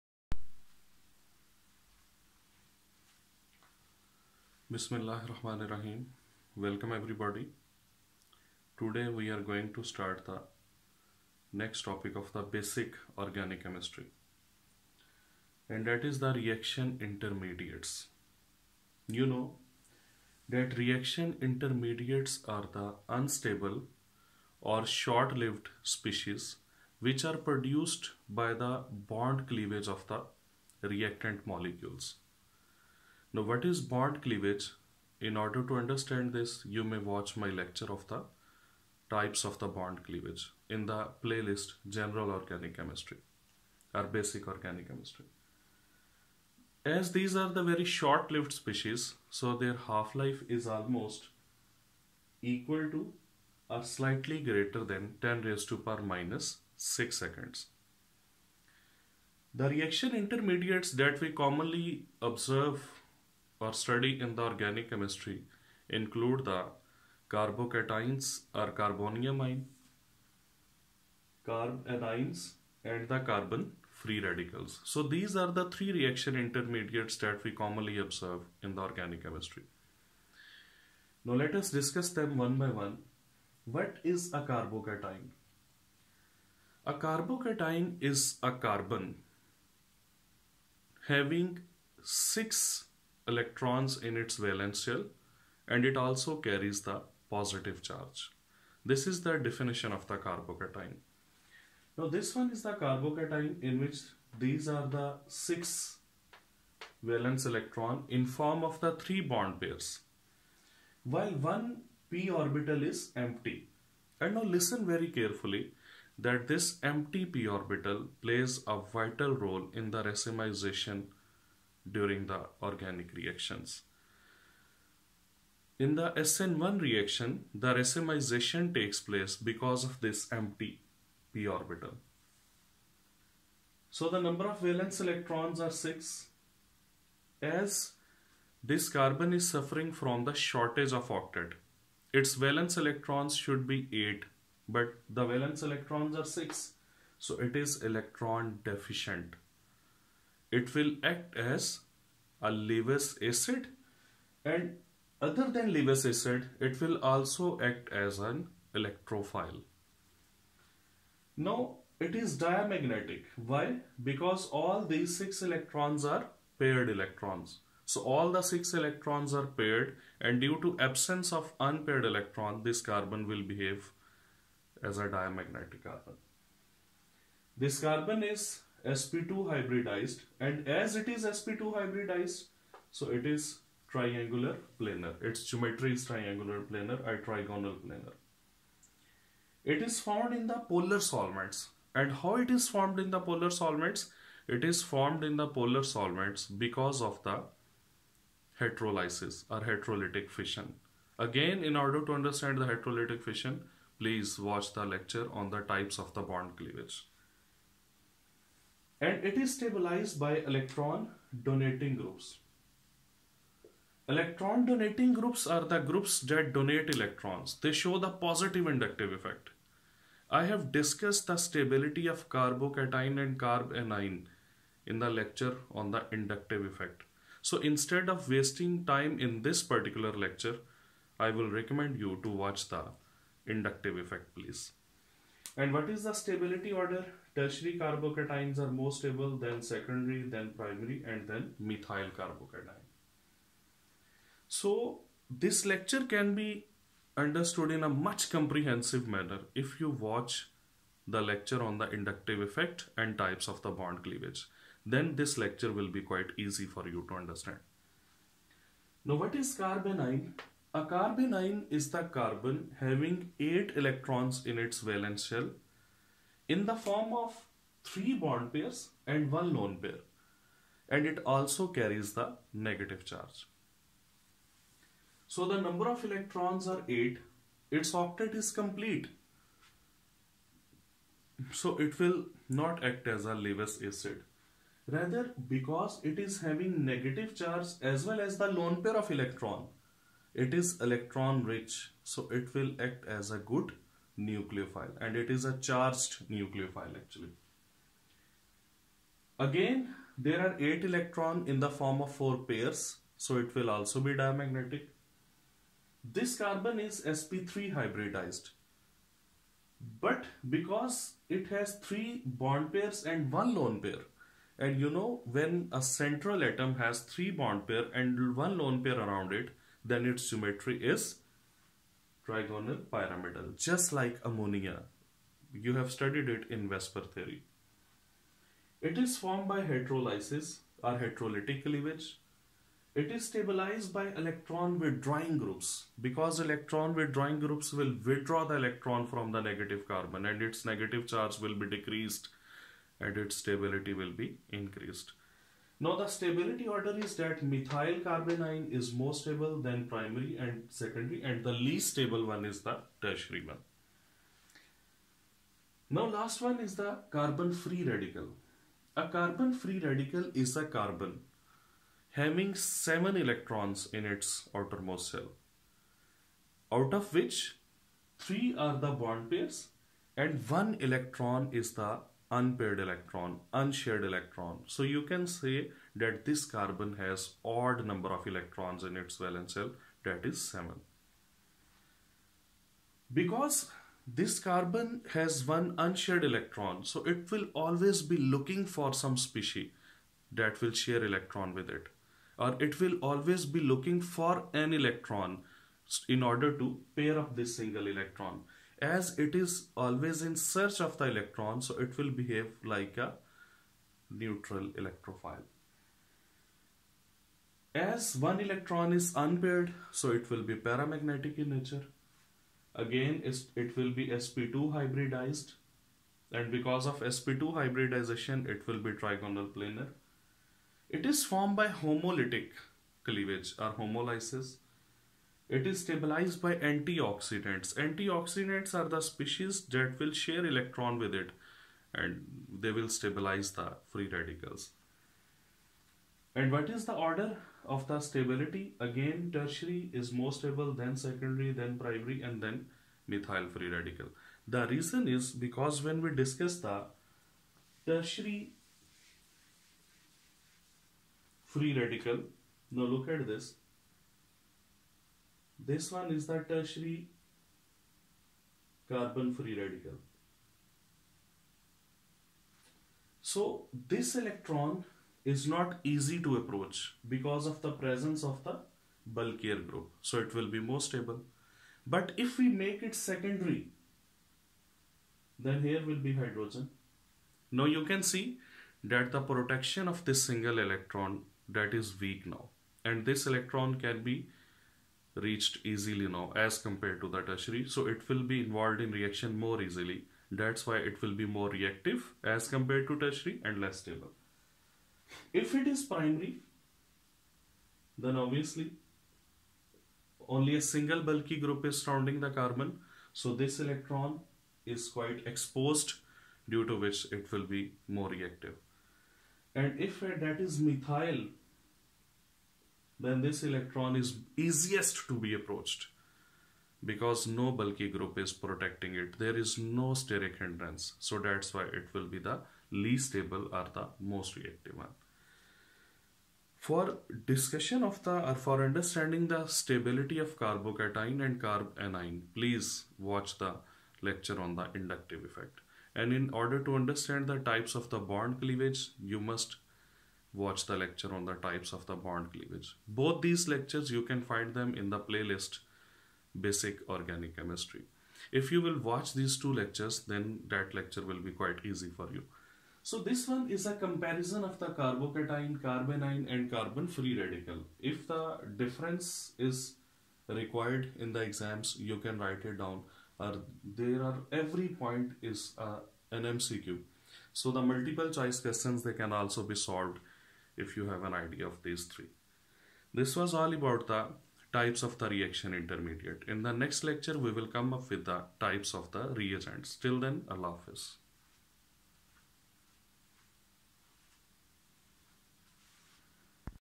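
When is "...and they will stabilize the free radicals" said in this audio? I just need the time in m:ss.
7:11.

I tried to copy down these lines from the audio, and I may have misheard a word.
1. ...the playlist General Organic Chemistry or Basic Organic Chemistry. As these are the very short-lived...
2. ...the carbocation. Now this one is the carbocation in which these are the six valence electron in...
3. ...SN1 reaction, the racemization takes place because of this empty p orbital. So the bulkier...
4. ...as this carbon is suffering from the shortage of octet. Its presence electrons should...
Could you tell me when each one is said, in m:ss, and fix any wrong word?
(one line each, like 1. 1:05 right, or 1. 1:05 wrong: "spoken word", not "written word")
1. 0:40 right
2. 1:40 right
3. 2:06 wrong: "number", not "bulkier"
4. 2:17 wrong: "valence", not "presence".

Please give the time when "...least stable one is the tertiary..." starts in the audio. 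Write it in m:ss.
5:51.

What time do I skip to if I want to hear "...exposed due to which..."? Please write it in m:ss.
8:25.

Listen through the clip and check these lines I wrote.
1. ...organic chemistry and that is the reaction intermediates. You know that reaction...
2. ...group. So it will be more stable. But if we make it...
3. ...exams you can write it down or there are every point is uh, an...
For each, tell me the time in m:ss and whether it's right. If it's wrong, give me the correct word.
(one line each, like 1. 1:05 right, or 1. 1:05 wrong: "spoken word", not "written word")
1. 0:13 right
2. 7:49 right
3. 9:21 right.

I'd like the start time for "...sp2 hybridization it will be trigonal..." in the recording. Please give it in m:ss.
6:57.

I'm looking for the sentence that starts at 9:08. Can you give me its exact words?
If you will watch these two lectures then that lecture will be quite easy for you.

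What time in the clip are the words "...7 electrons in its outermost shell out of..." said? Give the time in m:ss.
6:02.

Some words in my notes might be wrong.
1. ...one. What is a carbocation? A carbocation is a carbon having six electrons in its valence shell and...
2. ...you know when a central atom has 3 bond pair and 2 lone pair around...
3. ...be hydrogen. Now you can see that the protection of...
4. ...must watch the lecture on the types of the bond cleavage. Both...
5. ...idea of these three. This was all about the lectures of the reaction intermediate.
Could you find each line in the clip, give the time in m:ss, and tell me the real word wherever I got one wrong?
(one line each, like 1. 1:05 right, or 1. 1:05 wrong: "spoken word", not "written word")
1. 1:22 right
2. 5:14 wrong: "1", not "2"
3. 7:56 right
4. 8:59 right
5. 9:31 wrong: "types", not "lectures".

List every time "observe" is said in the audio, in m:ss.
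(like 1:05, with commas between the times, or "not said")
1:02, 1:17.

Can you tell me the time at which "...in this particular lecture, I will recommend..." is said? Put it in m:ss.
3:49.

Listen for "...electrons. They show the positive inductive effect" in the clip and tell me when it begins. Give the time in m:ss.
3:36.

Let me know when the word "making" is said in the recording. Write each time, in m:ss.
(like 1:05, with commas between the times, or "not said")
not said.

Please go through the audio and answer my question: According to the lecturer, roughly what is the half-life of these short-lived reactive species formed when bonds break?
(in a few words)
10^-6 seconds.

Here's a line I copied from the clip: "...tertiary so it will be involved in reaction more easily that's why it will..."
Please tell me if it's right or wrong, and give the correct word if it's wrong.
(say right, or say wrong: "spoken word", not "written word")
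right.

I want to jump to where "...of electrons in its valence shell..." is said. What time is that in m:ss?
6:18.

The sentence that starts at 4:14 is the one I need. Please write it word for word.
Then this lecture will be quite easy for you to understand.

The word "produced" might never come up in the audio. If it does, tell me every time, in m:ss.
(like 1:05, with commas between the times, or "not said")
0:27.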